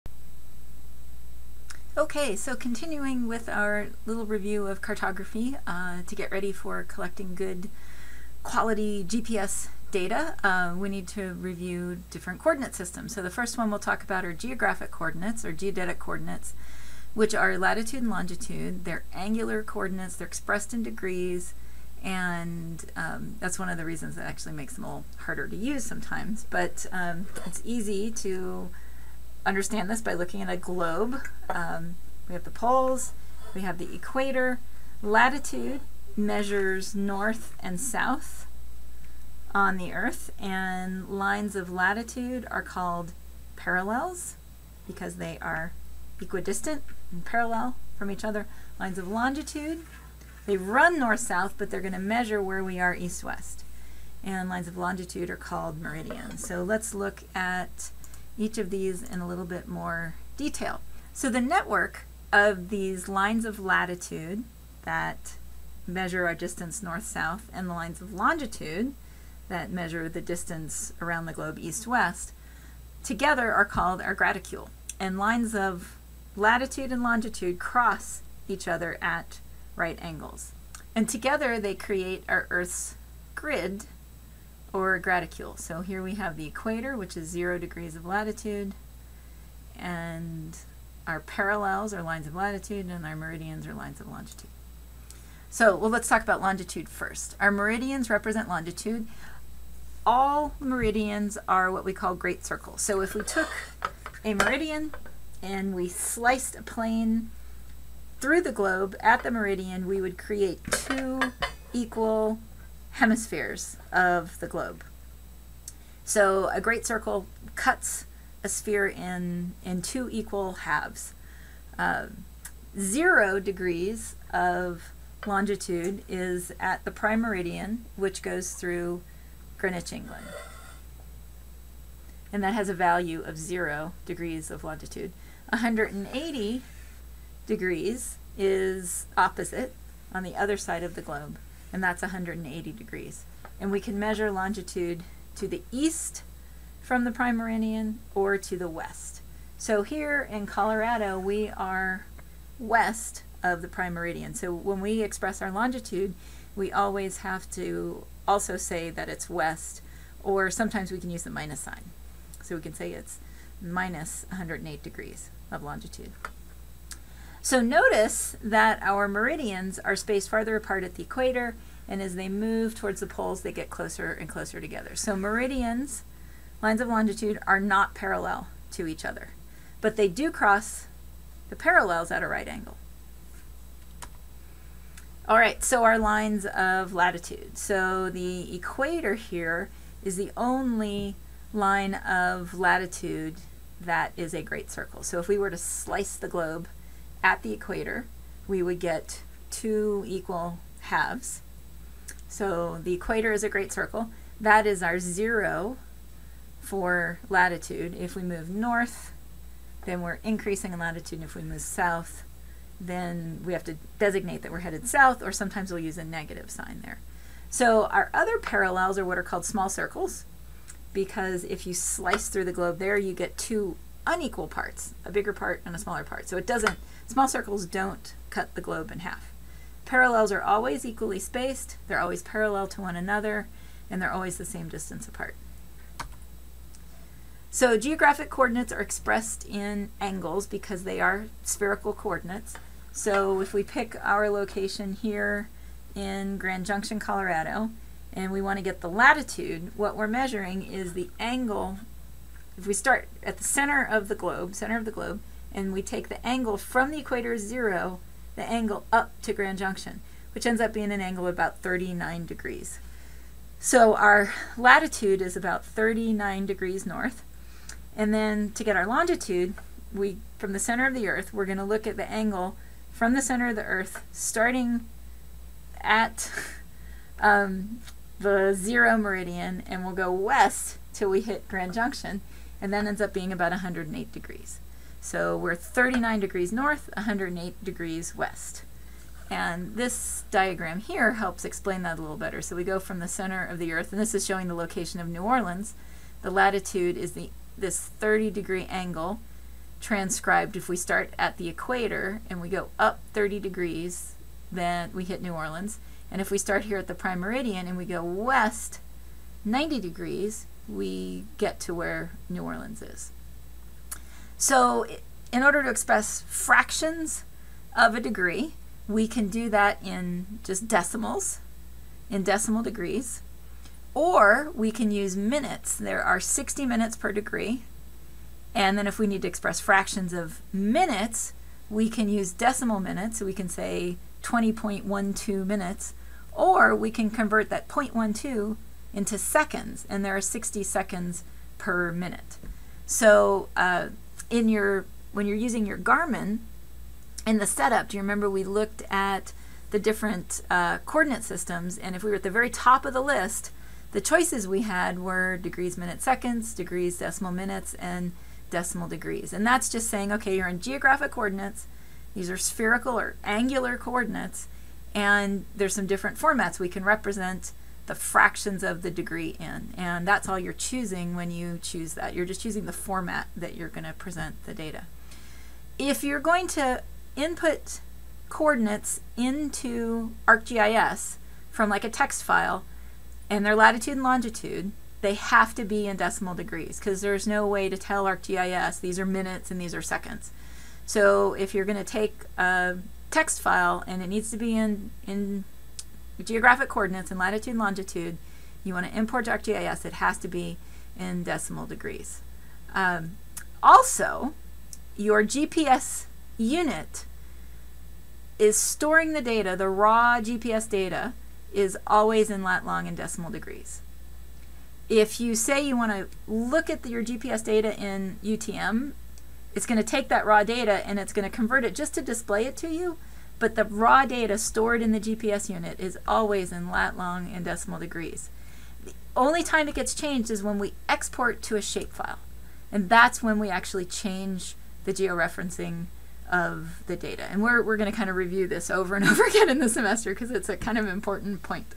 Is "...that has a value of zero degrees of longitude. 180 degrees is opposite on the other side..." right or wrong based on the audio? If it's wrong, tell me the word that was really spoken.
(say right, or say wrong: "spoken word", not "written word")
right.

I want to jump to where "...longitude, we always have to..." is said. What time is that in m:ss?
2:35.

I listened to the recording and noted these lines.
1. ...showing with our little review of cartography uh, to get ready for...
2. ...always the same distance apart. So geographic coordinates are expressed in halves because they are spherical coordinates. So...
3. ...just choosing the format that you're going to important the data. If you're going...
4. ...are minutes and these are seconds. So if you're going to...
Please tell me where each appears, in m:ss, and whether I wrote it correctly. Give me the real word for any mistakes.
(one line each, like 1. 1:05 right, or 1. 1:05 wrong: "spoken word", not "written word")
1. 0:02 wrong: "continuing", not "showing"
2. 3:54 wrong: "angles", not "halves"
3. 6:12 wrong: "present", not "important"
4. 6:28 right.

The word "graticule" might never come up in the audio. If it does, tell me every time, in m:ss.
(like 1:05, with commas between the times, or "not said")
1:14, 1:24.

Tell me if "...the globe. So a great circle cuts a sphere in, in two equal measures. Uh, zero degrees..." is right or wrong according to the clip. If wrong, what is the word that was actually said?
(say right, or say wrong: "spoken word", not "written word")
wrong: "halves", not "measures".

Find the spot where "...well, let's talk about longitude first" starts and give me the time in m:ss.
1:35.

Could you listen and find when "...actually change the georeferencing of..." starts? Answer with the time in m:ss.
7:13.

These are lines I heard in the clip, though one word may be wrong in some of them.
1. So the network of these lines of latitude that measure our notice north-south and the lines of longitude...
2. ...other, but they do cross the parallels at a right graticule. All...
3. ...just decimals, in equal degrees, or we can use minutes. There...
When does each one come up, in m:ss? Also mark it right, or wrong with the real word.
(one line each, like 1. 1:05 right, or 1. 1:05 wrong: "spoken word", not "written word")
1. 1:01 wrong: "distance", not "notice"
2. 2:59 wrong: "angle", not "graticule"
3. 5:20 wrong: "decimal", not "equal".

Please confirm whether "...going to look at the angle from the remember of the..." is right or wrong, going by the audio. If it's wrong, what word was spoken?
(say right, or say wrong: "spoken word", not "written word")
wrong: "center", not "remember".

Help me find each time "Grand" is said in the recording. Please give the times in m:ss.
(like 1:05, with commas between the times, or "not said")
4:06, 4:19, 4:41.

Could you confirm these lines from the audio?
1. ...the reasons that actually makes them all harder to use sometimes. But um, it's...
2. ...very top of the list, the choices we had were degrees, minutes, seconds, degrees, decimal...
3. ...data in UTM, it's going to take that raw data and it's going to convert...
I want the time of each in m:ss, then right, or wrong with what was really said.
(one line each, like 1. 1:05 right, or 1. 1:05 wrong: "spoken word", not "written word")
1. 0:23 right
2. 5:52 right
3. 6:57 right.